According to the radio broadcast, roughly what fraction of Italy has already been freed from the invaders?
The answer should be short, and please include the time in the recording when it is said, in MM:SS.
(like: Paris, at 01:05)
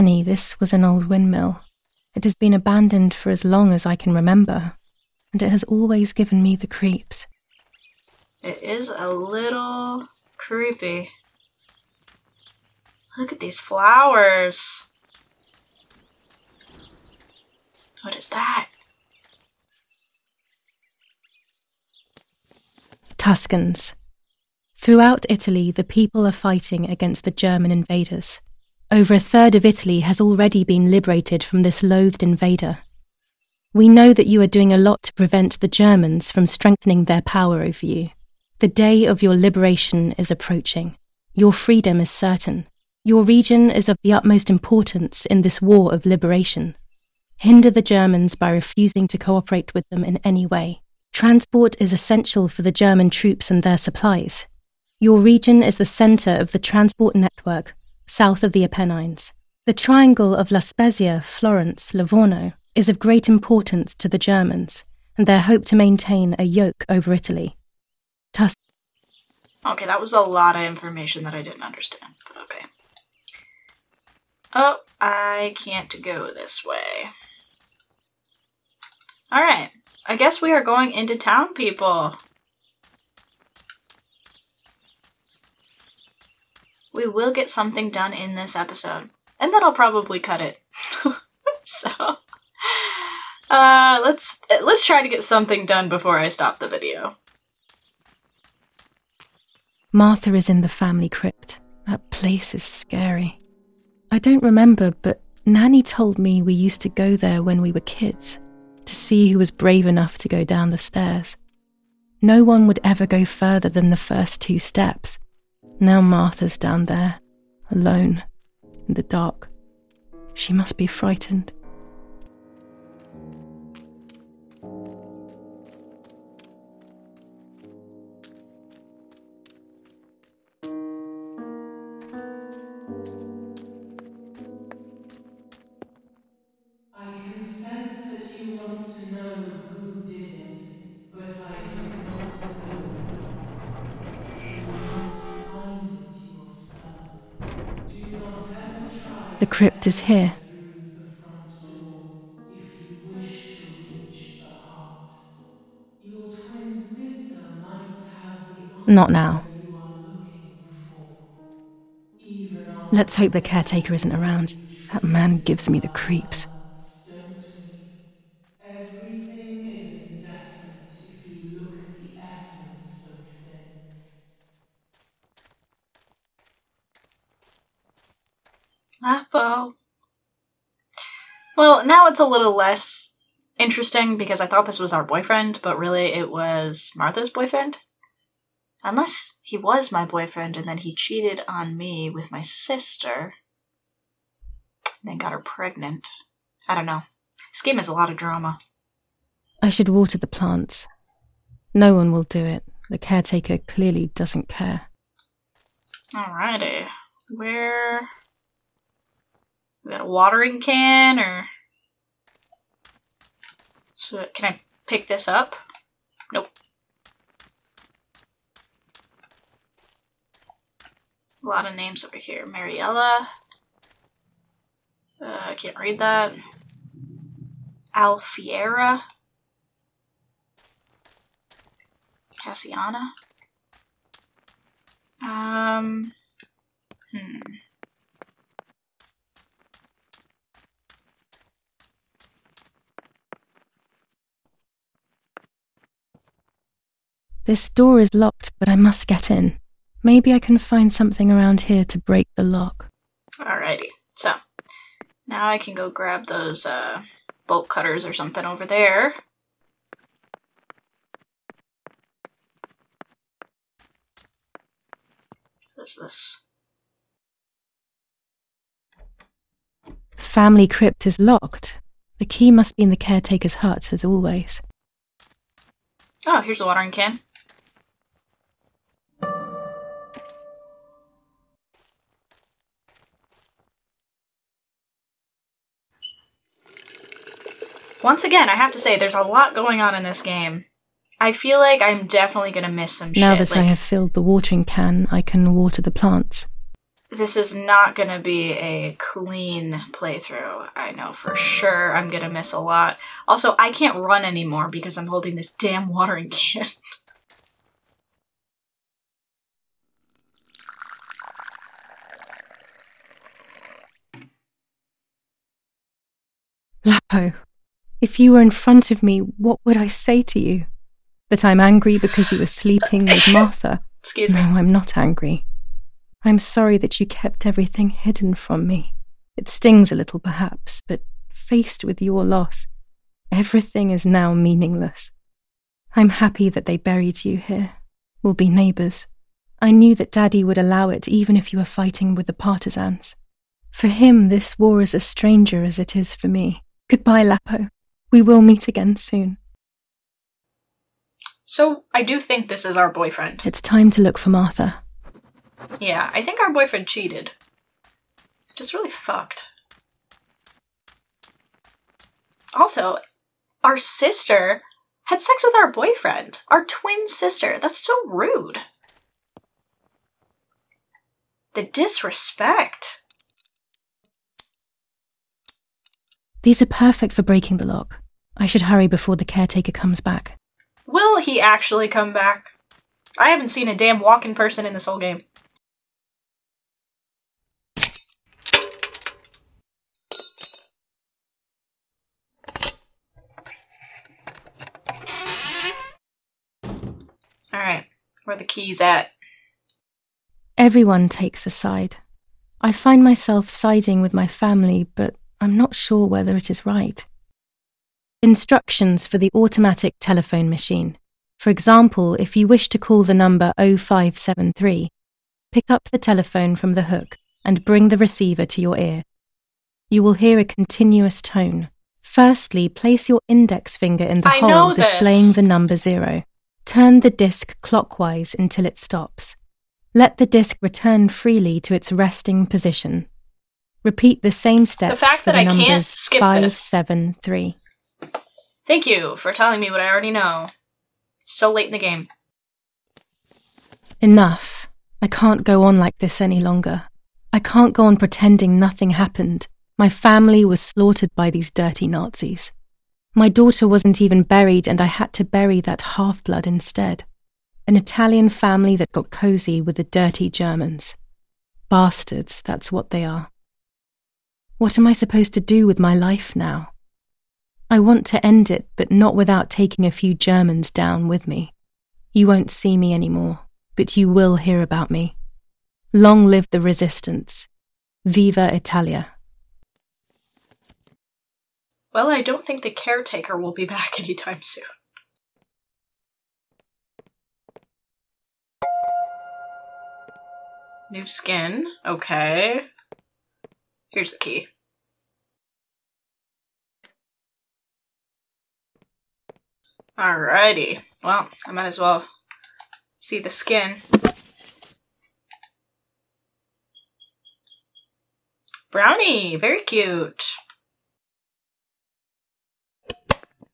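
Over a third, at 00:28.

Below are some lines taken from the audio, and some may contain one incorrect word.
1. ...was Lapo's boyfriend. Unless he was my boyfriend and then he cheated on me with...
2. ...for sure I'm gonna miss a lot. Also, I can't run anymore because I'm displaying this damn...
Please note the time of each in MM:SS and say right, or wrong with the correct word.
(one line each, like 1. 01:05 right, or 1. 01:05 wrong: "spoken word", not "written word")
1. 03:06 wrong: "Martha", not "Lapo"
2. 05:01 wrong: "holding", not "displaying".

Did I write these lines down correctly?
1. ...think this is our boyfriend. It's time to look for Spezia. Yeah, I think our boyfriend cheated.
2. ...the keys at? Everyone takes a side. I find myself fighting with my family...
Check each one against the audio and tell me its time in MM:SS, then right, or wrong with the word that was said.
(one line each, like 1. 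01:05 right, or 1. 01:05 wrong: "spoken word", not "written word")
1. 05:52 wrong: "Martha", not "Spezia"
2. 06:38 wrong: "siding", not "fighting".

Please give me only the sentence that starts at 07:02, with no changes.
Firstly, place your index finger in the I hole displaying the number 0.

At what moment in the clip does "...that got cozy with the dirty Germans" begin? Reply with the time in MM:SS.
07:38.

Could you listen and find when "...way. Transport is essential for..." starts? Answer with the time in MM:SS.
00:50.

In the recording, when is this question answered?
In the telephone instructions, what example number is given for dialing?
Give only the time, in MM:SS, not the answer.
06:53.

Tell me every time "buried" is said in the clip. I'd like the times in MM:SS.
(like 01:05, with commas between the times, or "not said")
05:36, 07:34.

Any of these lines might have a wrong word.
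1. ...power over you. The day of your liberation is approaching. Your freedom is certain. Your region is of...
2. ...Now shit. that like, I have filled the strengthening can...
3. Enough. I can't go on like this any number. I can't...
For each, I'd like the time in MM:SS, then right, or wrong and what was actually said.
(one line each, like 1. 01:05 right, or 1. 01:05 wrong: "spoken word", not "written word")
1. 00:37 right
2. 04:53 wrong: "watering", not "strengthening"
3. 07:24 wrong: "longer", not "number".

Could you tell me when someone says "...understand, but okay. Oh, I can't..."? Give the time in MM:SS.
01:11.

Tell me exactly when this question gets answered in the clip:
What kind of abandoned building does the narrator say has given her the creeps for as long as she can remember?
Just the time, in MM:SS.
00:00.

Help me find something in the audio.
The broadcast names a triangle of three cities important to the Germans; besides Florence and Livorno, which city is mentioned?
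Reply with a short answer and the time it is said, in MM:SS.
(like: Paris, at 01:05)
La Spezia, at 01:00.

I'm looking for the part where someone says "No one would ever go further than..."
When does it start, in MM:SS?
01:52.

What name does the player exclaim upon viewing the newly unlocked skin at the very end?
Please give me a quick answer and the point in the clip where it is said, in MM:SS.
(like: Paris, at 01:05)
Brownie, at 08:28.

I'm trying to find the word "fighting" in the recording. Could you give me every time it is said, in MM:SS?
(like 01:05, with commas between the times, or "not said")
00:26, 05:41.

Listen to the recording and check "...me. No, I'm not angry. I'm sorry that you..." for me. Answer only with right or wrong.
right.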